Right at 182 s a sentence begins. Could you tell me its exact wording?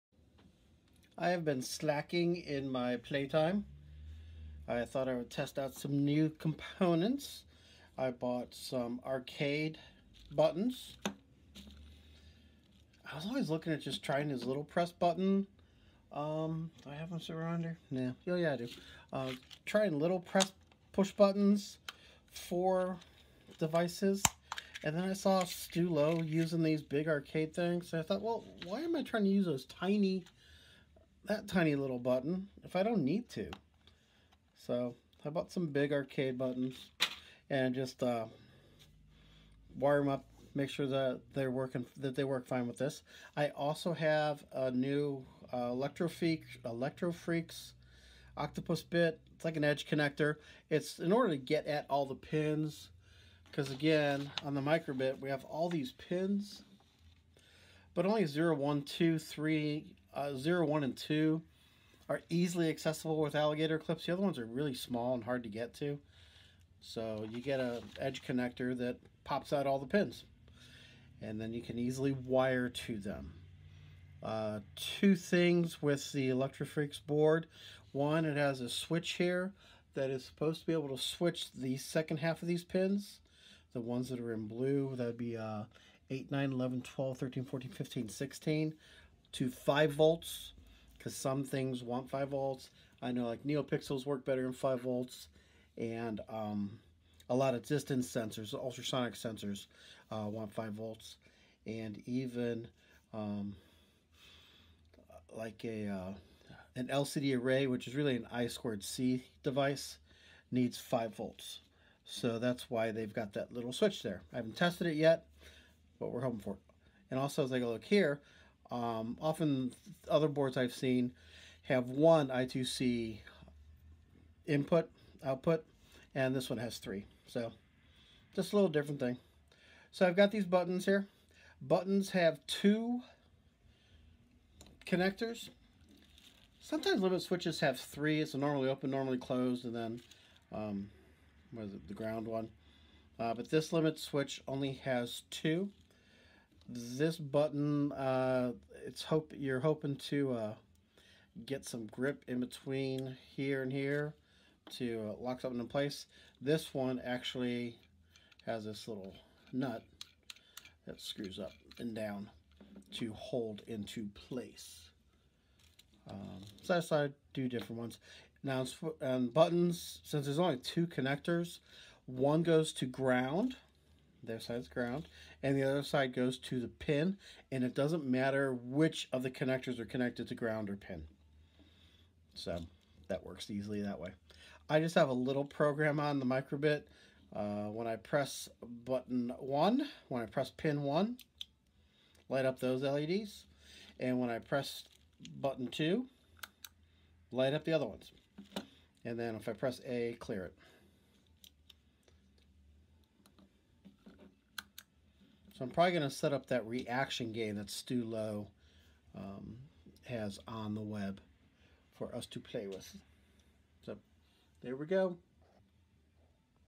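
So that works easily that way.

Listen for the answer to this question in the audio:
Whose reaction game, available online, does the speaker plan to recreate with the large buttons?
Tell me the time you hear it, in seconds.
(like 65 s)
207 s.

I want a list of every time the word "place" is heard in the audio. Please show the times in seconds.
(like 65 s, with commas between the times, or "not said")
155 s, 164 s.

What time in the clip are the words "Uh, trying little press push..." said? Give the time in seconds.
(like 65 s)
19 s.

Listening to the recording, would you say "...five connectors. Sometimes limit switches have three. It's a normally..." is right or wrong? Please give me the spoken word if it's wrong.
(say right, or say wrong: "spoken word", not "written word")
wrong: "two", not "five".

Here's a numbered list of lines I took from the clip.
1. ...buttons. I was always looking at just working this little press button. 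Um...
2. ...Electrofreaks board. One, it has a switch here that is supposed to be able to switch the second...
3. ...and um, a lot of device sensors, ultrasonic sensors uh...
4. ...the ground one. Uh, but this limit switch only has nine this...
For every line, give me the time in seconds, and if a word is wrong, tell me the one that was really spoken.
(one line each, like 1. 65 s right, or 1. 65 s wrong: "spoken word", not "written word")
1. 10 s wrong: "trying", not "working"
2. 76 s right
3. 95 s wrong: "distance", not "device"
4. 141 s wrong: "two", not "nine".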